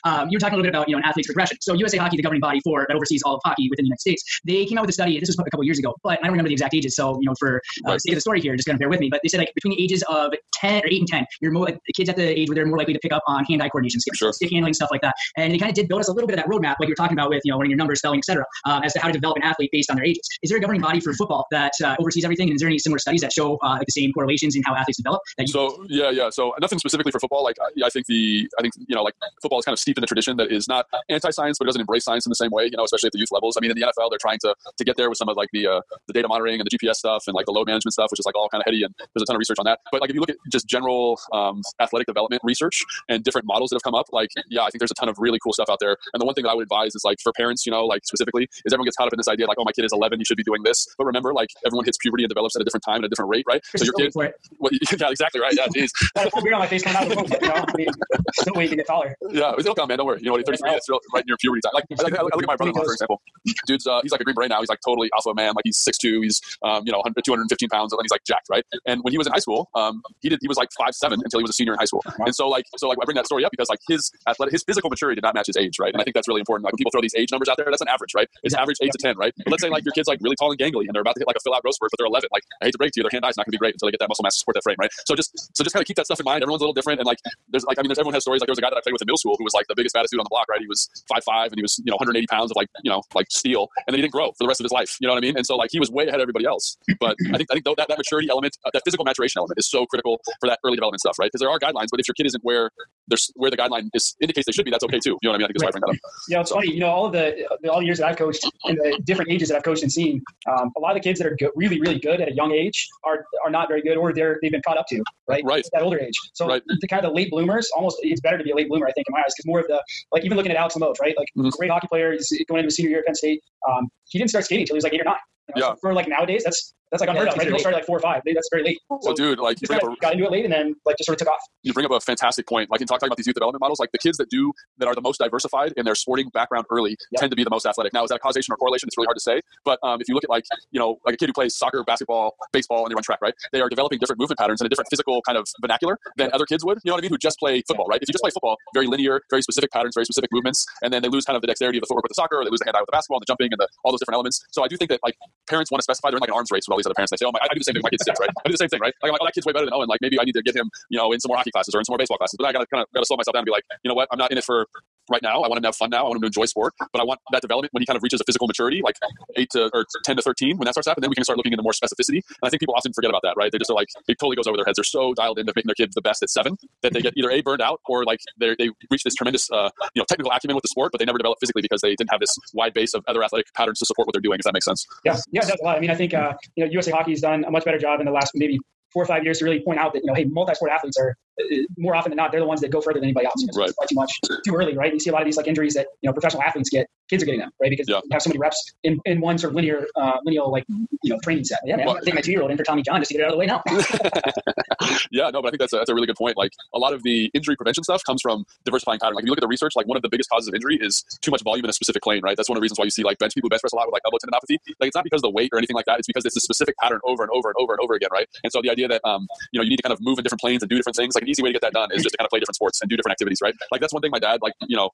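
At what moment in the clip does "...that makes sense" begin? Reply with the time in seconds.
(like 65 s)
184 s.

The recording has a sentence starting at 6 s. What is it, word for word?
So you know, for uh, right.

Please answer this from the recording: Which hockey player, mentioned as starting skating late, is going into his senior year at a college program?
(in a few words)
Alex Limoges.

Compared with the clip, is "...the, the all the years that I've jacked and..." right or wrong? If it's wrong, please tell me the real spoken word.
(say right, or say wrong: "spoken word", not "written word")
wrong: "coached", not "jacked".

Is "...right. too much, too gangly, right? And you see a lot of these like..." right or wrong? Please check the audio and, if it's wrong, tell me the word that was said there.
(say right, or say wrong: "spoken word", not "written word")
wrong: "early", not "gangly".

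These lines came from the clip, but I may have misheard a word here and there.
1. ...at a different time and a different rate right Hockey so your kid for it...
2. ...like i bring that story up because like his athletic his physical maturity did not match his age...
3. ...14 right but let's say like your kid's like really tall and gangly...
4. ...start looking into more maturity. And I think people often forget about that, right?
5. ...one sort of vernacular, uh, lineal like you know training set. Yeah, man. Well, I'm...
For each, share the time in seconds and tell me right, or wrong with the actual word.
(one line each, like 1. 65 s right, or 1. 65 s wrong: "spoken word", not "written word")
1. 52 s wrong: "Chris", not "Hockey"
2. 72 s right
3. 78 s wrong: "10", not "14"
4. 171 s wrong: "specificity", not "maturity"
5. 199 s wrong: "linear", not "vernacular".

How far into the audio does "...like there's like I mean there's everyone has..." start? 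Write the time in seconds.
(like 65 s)
87 s.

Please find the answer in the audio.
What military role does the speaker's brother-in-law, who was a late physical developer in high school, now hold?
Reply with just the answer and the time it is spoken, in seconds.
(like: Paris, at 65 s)
Green Beret, at 64 s.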